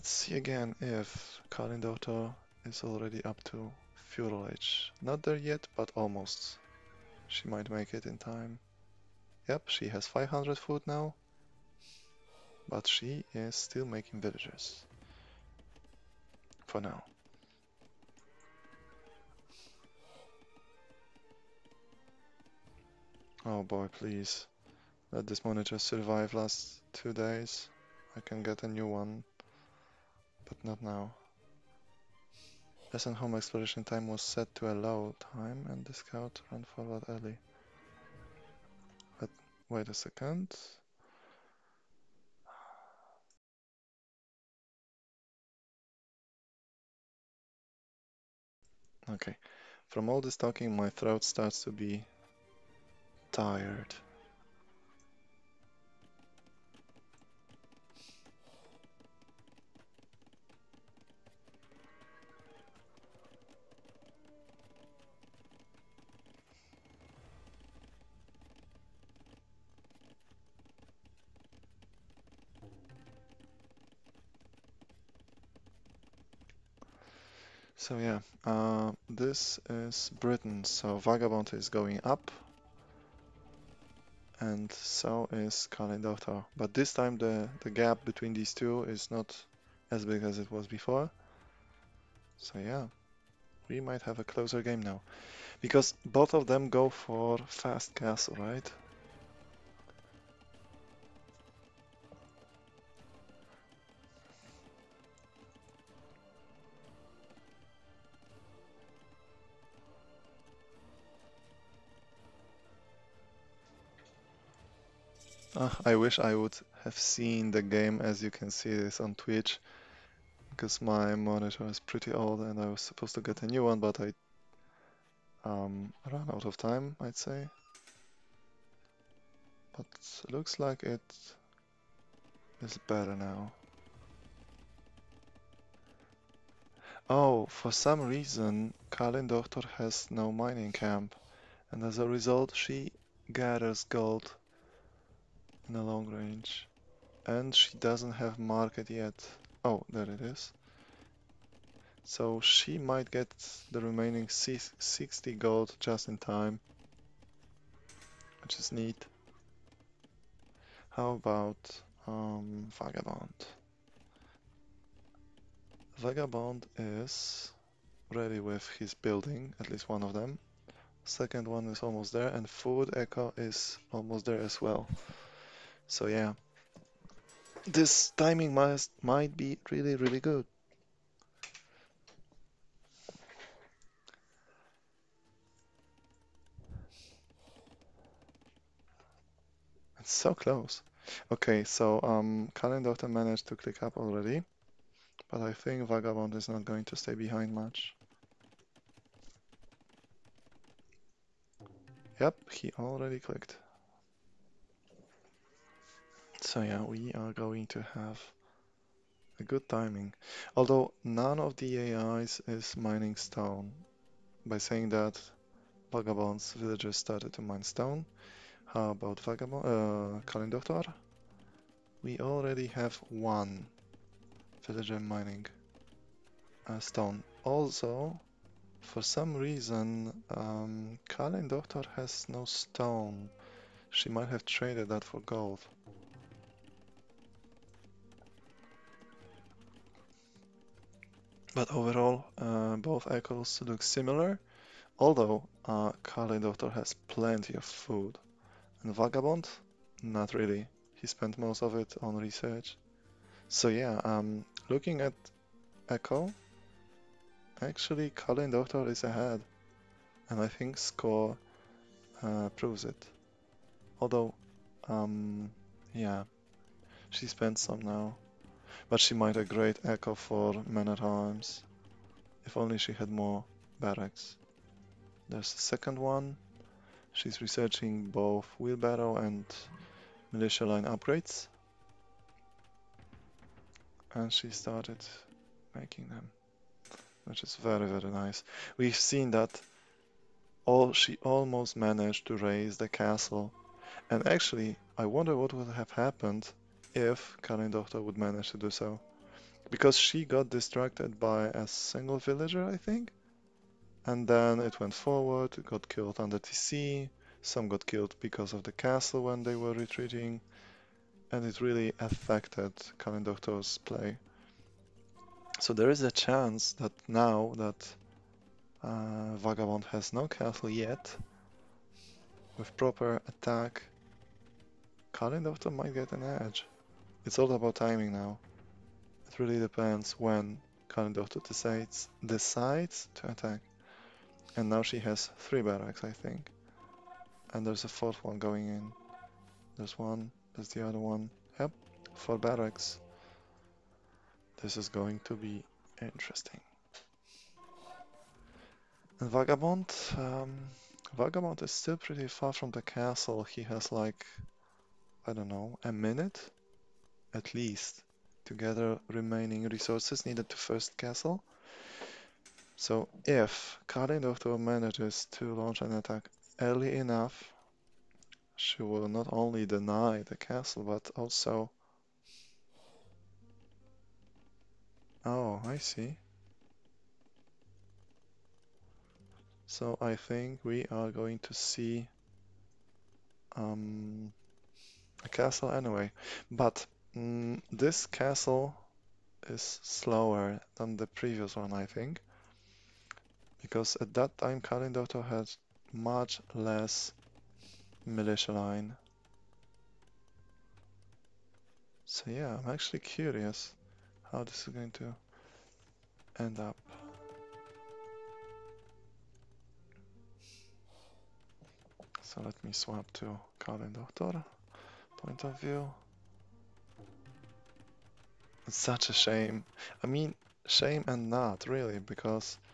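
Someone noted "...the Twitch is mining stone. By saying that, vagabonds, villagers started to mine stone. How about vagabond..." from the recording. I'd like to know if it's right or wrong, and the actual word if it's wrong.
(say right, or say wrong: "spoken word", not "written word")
wrong: "AIs", not "Twitch".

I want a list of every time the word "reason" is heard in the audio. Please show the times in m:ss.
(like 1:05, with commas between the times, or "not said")
2:18, 3:49.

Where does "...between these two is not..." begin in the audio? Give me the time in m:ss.
1:28.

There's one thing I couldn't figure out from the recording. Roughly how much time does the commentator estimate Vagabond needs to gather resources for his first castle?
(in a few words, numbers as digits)
A minute.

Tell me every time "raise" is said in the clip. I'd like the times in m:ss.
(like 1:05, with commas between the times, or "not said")
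4:52.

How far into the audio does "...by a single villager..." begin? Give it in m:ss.
5:01.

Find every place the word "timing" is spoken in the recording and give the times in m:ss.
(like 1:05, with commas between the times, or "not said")
2:58, 3:29, 5:27.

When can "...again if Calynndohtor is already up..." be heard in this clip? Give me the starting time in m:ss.
0:00.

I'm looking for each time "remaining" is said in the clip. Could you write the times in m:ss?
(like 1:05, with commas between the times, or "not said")
2:33, 5:59.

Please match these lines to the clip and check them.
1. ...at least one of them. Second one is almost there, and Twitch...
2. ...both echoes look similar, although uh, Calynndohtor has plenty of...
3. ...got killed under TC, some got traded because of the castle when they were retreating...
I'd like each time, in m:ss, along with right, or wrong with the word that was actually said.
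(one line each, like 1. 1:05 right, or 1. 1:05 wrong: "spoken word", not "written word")
1. 2:49 wrong: "Food", not "Twitch"
2. 4:02 right
3. 5:05 wrong: "killed", not "traded".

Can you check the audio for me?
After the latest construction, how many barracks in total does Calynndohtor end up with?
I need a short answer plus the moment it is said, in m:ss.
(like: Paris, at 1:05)
4, at 5:42.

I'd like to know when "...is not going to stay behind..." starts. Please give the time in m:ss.
3:16.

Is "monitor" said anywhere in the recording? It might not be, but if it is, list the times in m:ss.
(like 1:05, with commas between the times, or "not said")
0:25, 2:01.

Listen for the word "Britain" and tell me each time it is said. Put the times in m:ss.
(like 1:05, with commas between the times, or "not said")
1:20.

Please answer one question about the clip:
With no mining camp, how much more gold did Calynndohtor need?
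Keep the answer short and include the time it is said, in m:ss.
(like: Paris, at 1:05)
60, at 2:34.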